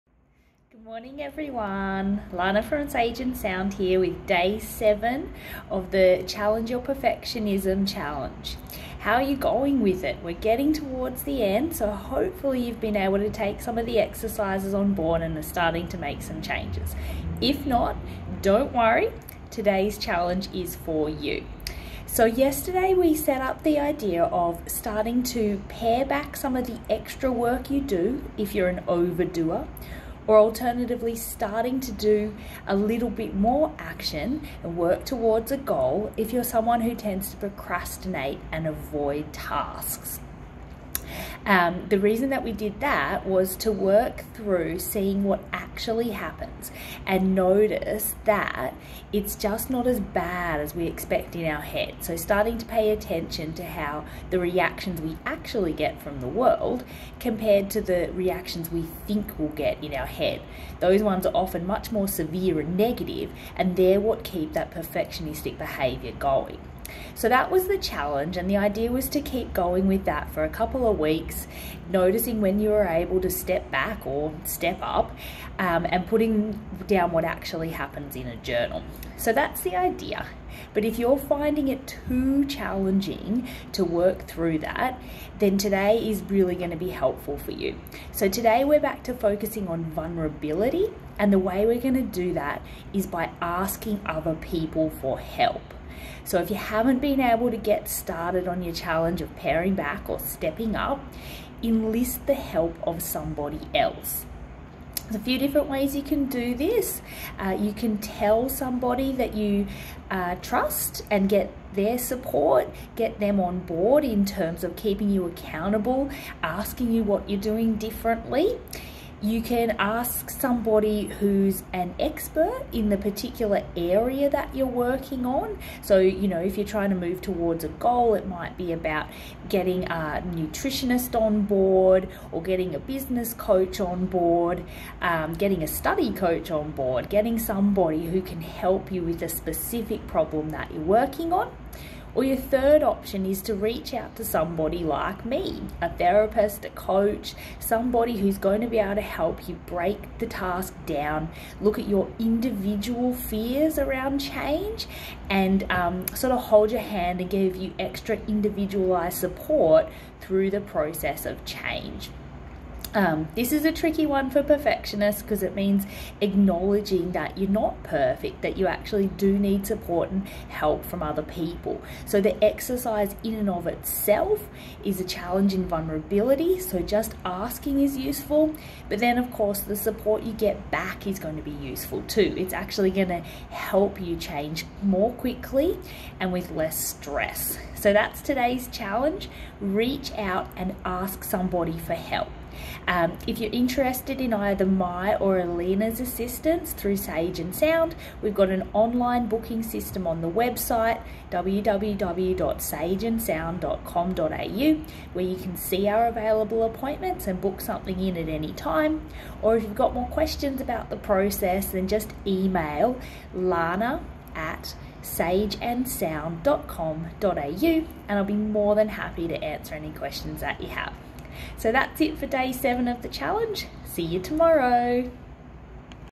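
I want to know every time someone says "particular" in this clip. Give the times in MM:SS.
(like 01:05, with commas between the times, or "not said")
02:02.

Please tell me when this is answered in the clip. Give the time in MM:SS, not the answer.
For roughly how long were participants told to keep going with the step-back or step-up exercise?
01:10.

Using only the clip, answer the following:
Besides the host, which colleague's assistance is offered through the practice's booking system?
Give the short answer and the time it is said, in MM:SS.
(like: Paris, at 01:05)
Alina, at 03:15.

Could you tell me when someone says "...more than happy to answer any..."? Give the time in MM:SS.
03:38.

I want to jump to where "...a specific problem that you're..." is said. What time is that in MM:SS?
02:19.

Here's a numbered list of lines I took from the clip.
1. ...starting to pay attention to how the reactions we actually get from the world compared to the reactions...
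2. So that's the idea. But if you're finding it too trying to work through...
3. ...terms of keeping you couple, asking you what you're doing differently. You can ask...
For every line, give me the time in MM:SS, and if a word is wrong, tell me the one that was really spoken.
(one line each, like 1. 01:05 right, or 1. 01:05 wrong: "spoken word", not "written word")
1. 00:52 right
2. 01:19 wrong: "challenging", not "trying"
3. 01:54 wrong: "accountable", not "couple".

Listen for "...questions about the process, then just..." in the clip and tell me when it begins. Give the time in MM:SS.
03:30.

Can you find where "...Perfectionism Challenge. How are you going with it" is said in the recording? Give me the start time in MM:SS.
00:06.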